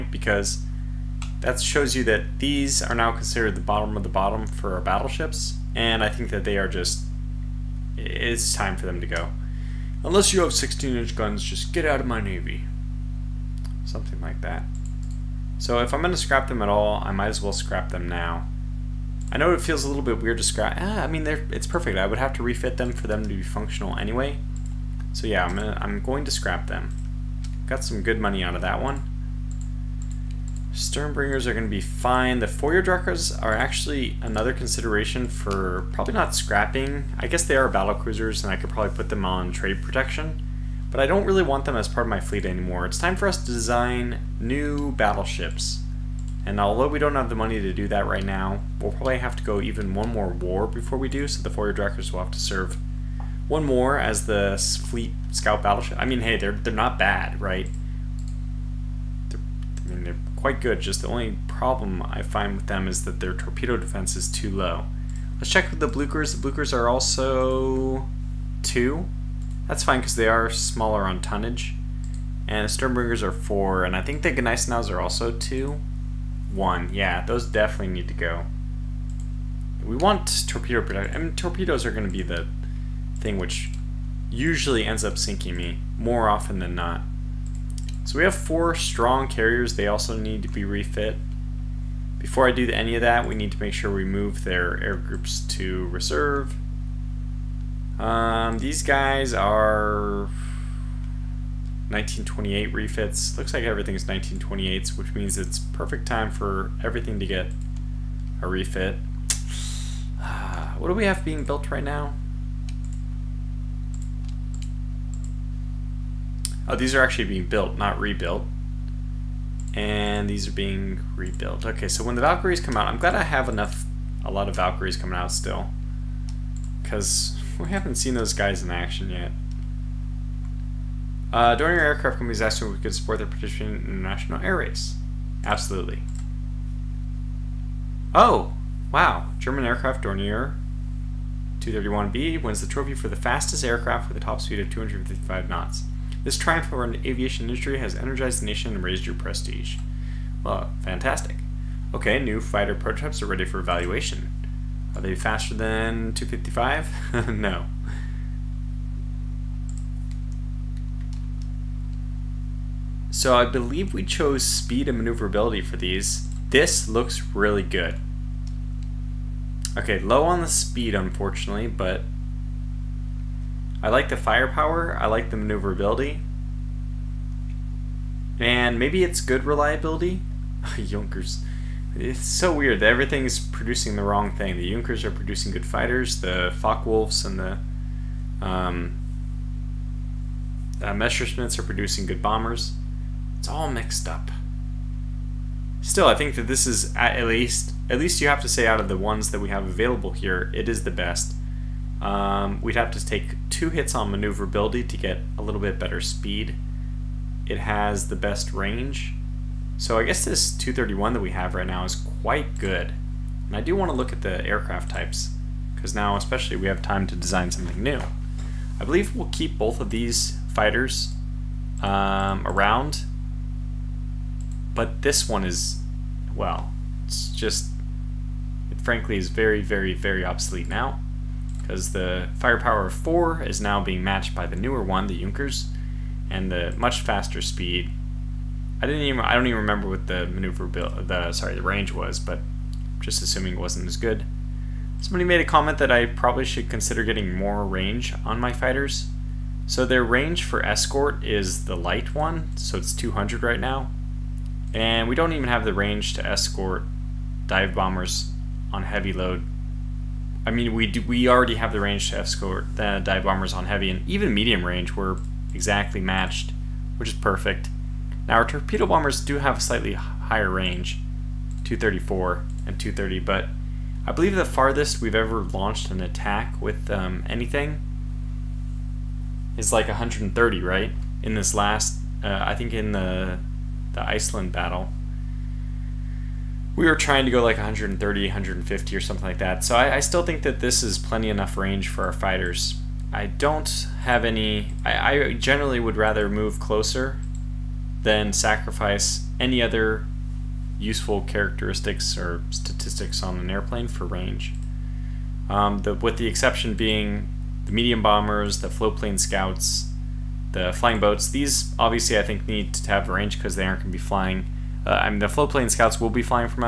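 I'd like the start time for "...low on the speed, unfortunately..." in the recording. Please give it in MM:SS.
02:50.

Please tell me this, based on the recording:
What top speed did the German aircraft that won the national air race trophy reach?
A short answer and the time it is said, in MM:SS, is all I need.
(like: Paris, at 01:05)
255 knots, at 02:24.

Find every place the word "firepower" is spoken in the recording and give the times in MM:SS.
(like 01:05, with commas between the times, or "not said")
02:54, 03:52.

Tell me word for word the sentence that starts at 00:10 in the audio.
Unless you have 16-inch guns, just get out of my navy.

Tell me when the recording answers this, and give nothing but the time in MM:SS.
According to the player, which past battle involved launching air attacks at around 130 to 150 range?
04:44.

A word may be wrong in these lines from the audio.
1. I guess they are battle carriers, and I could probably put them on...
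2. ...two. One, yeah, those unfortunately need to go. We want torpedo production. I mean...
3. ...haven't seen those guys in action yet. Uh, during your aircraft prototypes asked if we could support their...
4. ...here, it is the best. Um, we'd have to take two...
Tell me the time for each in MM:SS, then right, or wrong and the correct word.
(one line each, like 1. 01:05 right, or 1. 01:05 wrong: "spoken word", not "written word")
1. 00:37 wrong: "cruisers", not "carriers"
2. 01:15 wrong: "definitely", not "unfortunately"
3. 02:07 wrong: "companies", not "prototypes"
4. 03:20 right.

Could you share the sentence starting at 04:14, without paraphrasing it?
And we don't even have the range to escort dive bombers on heavy load.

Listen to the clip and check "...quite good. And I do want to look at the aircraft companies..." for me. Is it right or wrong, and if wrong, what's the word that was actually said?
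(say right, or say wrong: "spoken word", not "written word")
wrong: "types", not "companies".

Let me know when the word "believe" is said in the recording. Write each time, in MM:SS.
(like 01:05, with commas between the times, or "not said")
02:43, 03:38, 04:34.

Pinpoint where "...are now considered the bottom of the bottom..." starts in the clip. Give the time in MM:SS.
00:02.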